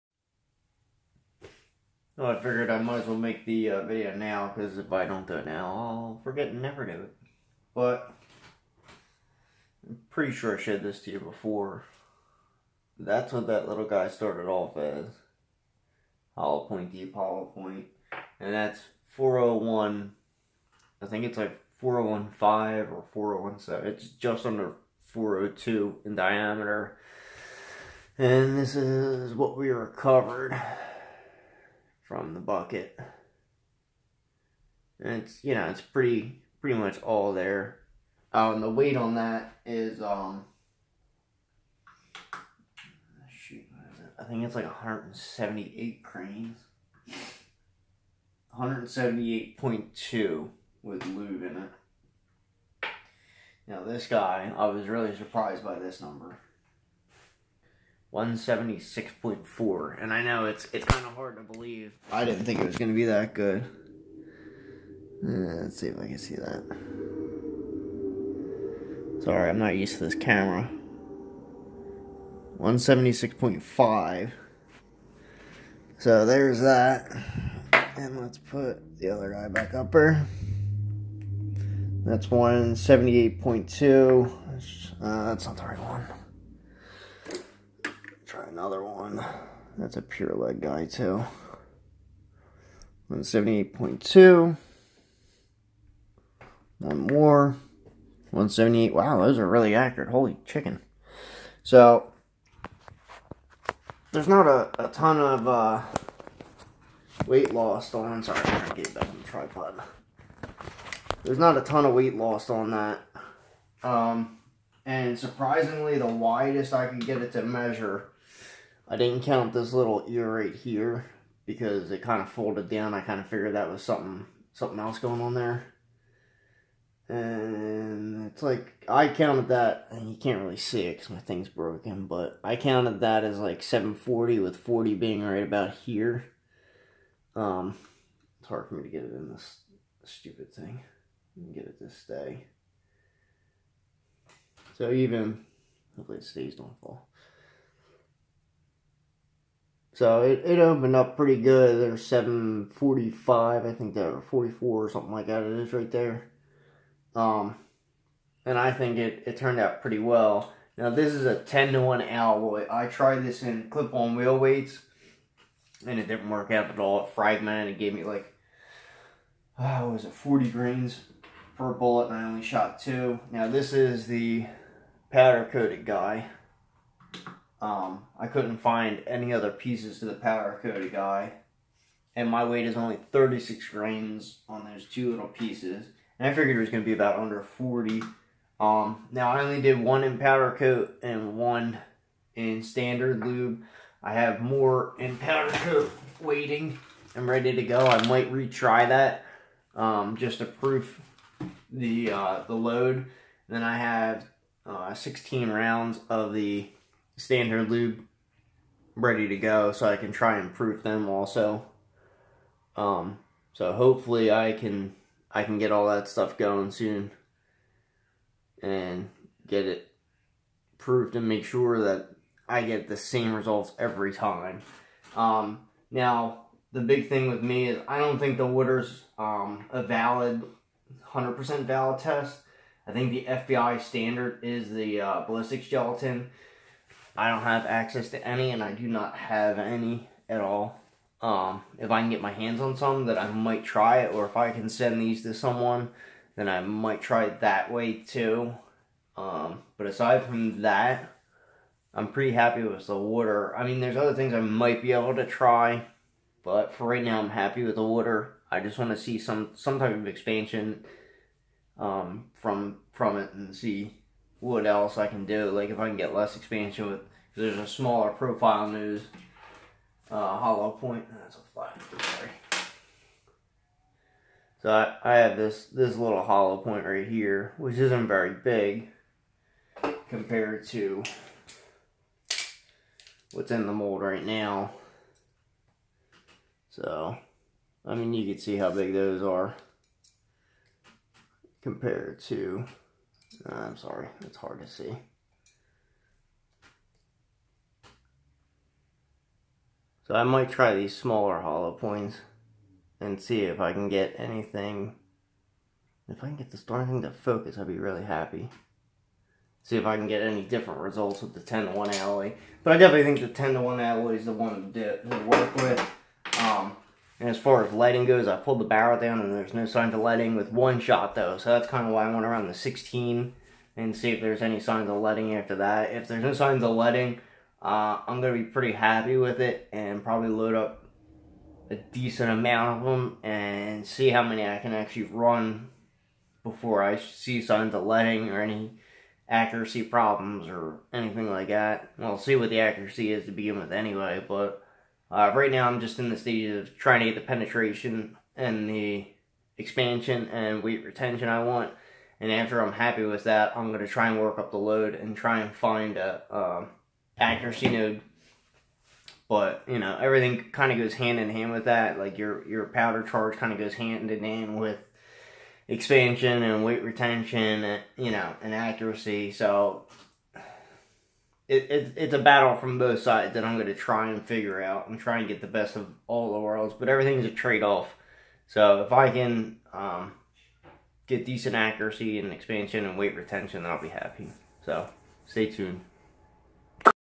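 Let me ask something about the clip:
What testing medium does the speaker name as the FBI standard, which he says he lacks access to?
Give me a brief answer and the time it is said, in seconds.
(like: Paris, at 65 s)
ballistics gelatin, at 235 s.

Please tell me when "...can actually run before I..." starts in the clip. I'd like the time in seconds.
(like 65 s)
334 s.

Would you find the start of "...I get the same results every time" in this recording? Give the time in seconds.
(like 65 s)
222 s.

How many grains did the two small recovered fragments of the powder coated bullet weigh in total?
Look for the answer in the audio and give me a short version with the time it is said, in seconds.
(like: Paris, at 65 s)
36 grains, at 183 s.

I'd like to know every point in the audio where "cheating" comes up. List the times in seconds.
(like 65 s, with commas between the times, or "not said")
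not said.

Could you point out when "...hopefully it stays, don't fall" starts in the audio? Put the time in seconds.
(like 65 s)
145 s.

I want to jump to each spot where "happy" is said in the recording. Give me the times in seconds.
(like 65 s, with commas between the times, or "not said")
252 s, 257 s, 308 s, 328 s, 352 s, 383 s.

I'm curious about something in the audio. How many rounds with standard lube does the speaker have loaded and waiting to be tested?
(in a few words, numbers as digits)
16.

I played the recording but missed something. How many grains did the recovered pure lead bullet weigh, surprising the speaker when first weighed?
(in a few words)
176.4.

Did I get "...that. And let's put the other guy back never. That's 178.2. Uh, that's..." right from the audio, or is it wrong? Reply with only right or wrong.
wrong.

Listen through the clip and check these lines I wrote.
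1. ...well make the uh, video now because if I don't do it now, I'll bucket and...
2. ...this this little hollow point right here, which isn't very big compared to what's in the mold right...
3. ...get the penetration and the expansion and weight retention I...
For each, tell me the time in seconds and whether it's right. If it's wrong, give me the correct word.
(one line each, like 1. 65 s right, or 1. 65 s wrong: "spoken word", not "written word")
1. 3 s wrong: "forget", not "bucket"
2. 275 s right
3. 347 s right.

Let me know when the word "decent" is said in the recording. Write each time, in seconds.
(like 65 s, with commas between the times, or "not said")
331 s, 381 s.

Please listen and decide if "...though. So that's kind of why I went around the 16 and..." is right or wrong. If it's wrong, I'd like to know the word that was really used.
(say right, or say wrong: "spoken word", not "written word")
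right.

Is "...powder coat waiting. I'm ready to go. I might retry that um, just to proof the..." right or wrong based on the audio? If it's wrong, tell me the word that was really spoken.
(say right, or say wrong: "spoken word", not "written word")
right.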